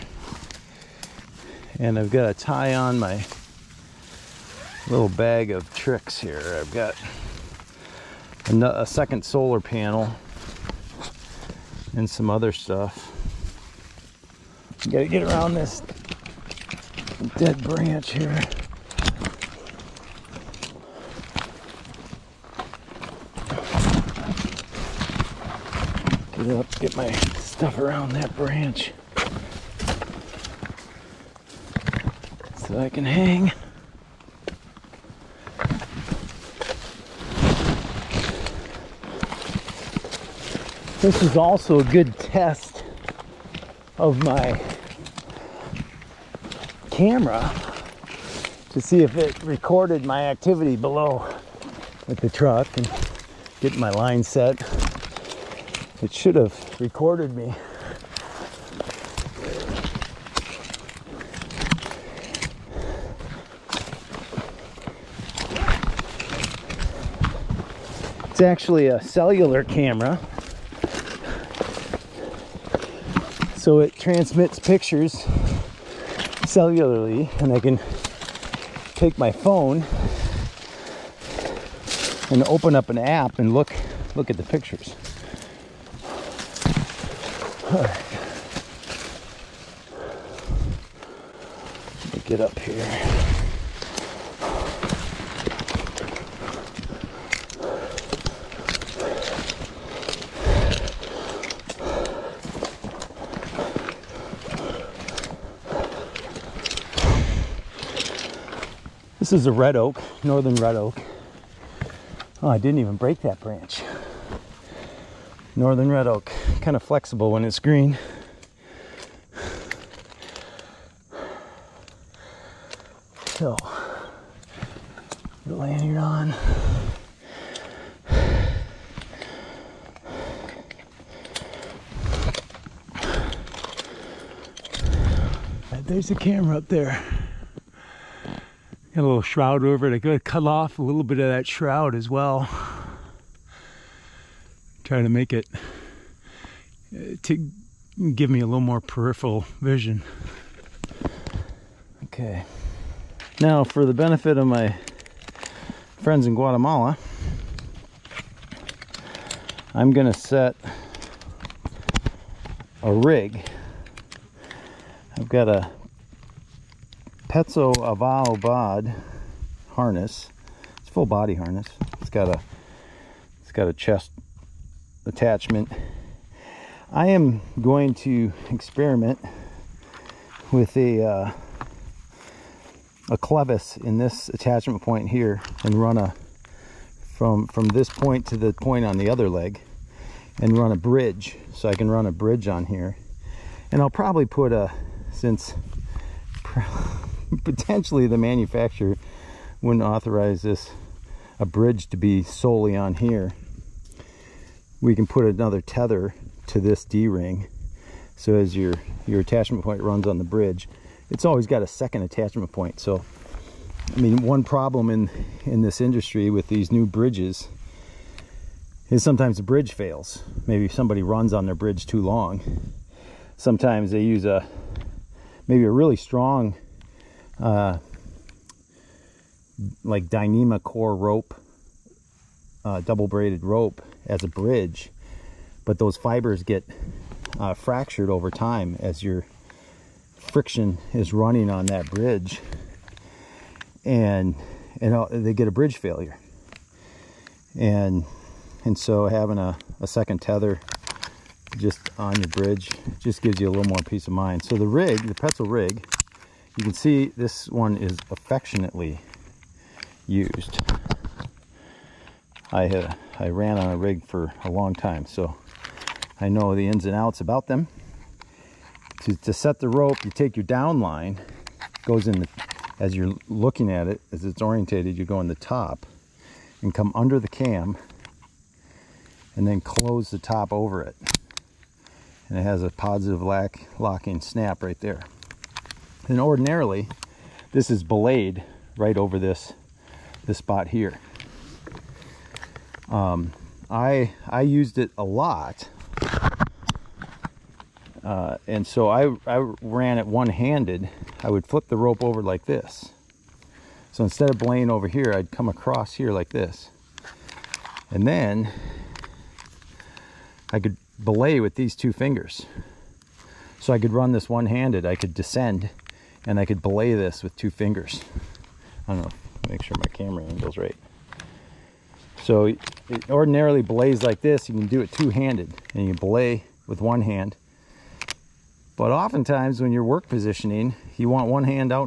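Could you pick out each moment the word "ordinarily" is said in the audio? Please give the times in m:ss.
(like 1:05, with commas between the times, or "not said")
4:46, 5:23.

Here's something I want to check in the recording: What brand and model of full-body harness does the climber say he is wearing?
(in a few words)
Petzl Avao Bod.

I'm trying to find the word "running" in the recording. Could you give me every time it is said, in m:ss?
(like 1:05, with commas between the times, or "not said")
4:01.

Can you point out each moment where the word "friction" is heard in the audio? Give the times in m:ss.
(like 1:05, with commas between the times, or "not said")
4:00.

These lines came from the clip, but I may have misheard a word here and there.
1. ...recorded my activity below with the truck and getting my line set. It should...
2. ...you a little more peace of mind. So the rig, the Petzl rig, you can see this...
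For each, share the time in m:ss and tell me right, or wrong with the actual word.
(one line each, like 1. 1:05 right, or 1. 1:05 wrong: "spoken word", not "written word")
1. 0:49 right
2. 4:13 right.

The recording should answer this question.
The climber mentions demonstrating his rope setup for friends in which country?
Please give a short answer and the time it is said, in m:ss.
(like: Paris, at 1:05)
Guatemala, at 2:36.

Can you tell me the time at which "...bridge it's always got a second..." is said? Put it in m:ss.
3:30.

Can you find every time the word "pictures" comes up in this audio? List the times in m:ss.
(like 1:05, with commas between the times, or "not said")
1:14, 1:24.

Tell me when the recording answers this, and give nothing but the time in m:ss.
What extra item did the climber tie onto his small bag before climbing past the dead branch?
0:08.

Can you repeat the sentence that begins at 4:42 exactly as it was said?
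And it has a positive lock, locking snap right there.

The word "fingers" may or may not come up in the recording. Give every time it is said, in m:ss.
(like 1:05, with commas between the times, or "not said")
5:11, 5:17.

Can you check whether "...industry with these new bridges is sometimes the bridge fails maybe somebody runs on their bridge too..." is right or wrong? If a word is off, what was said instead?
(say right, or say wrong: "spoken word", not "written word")
right.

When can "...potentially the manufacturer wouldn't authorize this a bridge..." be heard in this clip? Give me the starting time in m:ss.
3:17.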